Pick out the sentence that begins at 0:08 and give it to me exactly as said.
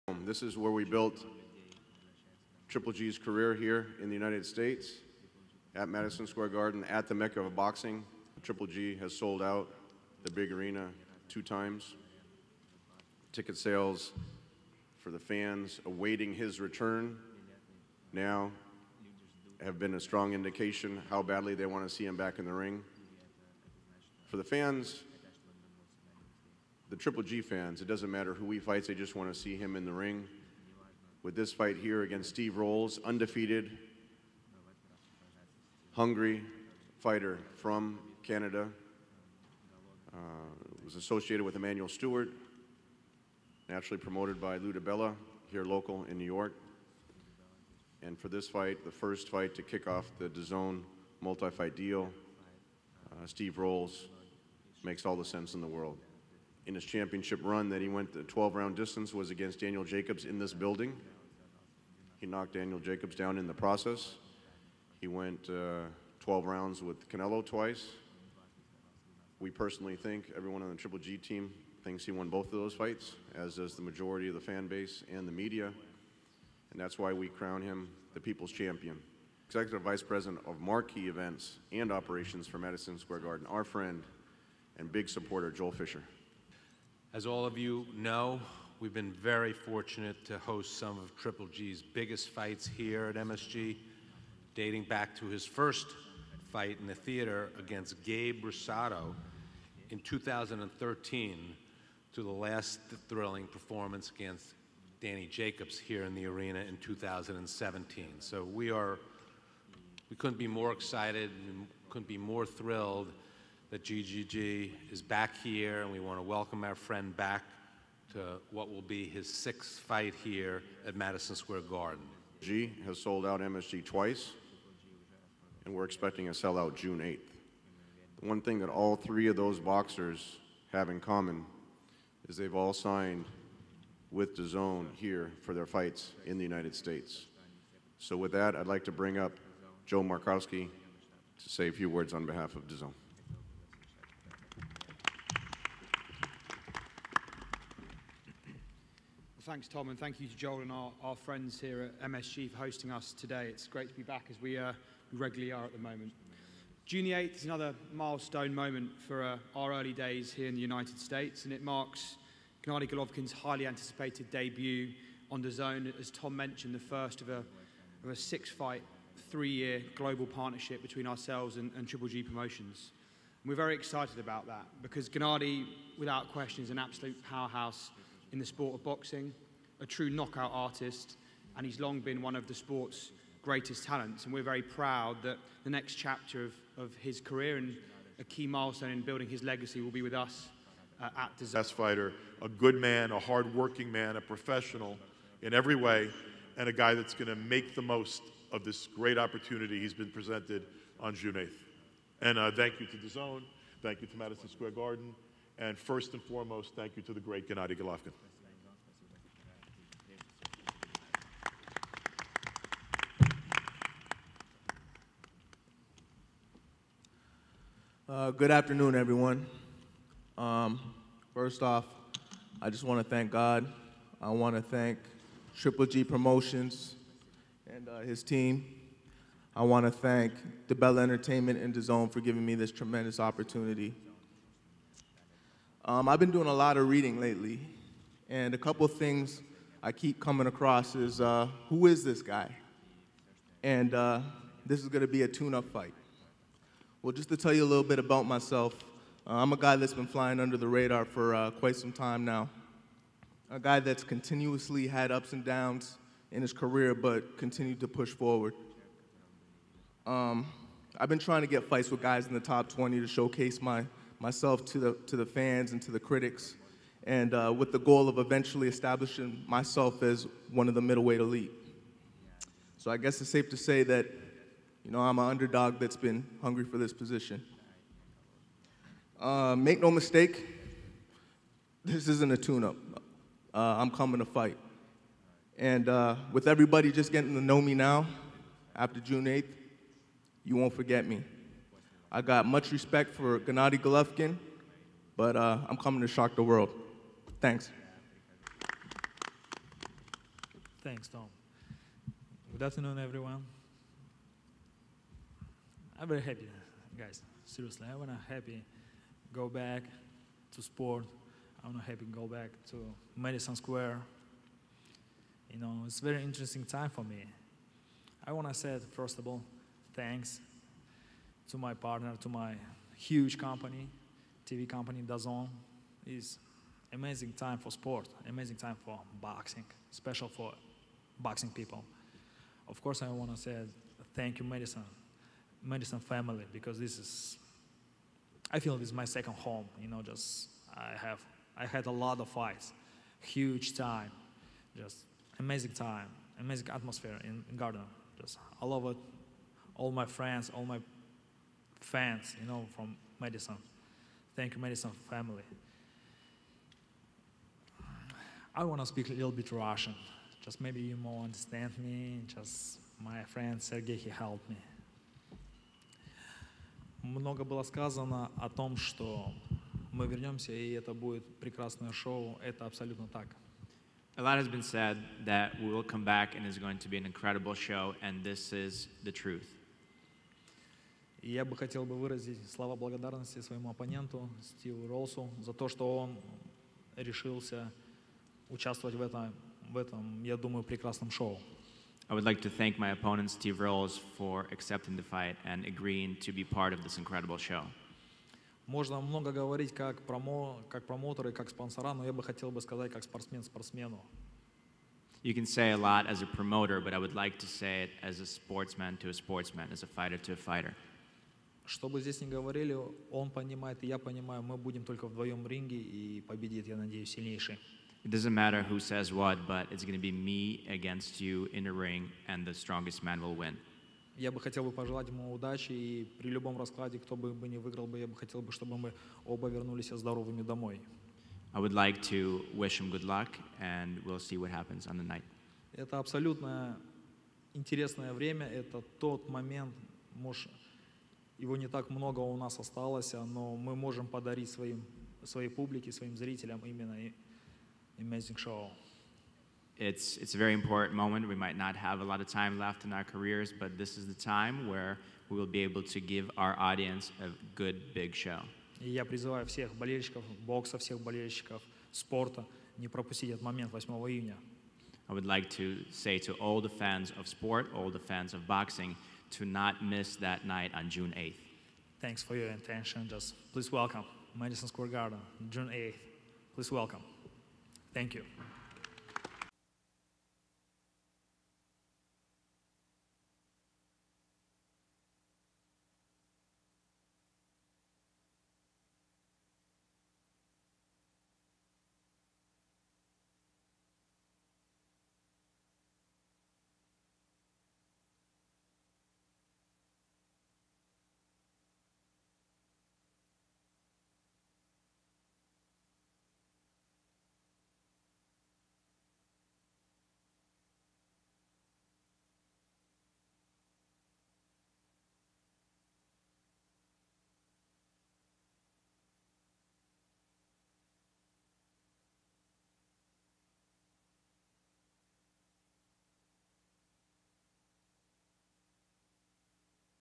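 Triple G has sold out the big arena two times.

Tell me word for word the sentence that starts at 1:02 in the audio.
He knocked Daniel Jacobs down in the process.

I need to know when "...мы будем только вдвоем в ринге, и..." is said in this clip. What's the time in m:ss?
6:54.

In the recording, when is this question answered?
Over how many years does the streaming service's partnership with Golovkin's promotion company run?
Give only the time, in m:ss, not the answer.
2:49.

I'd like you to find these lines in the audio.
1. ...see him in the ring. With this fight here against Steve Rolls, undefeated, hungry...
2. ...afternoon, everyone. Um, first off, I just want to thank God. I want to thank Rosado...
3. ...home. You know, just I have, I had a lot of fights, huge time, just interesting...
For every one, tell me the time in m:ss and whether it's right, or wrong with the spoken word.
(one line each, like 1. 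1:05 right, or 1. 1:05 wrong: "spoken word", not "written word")
1. 0:29 right
2. 3:38 wrong: "Triple", not "Rosado"
3. 5:39 wrong: "amazing", not "interesting".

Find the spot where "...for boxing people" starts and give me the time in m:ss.
5:30.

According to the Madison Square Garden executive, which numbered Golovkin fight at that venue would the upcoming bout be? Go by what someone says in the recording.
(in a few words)
sixth.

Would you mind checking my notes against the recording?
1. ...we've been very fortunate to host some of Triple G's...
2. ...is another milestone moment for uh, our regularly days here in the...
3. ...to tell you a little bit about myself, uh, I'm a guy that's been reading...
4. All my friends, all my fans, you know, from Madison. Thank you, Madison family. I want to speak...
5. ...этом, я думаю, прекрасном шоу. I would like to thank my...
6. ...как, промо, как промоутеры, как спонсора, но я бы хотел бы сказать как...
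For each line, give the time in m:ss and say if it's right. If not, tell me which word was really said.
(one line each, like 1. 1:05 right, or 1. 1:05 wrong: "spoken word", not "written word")
1. 1:28 right
2. 2:37 wrong: "early", not "regularly"
3. 4:07 wrong: "flying", not "reading"
4. 5:49 right
5. 6:29 right
6. 6:39 right.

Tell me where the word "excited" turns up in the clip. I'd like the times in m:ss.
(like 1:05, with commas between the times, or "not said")
1:50, 2:53.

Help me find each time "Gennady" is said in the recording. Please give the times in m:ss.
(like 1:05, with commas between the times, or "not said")
2:42, 2:55, 3:27, 4:53.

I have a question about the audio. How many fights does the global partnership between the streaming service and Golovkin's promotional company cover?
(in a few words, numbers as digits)
6.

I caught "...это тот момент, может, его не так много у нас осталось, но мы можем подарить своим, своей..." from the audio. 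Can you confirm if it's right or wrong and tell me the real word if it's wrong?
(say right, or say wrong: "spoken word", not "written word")
right.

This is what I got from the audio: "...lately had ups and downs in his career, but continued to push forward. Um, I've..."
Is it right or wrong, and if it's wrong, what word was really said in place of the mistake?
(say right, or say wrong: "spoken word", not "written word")
wrong: "continuously", not "lately".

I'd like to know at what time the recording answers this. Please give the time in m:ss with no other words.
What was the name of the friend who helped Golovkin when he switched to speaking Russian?
6:03.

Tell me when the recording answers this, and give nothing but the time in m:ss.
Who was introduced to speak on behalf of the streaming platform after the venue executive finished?
2:19.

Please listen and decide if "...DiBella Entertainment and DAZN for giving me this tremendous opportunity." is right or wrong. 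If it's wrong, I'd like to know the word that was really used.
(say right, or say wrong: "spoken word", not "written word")
right.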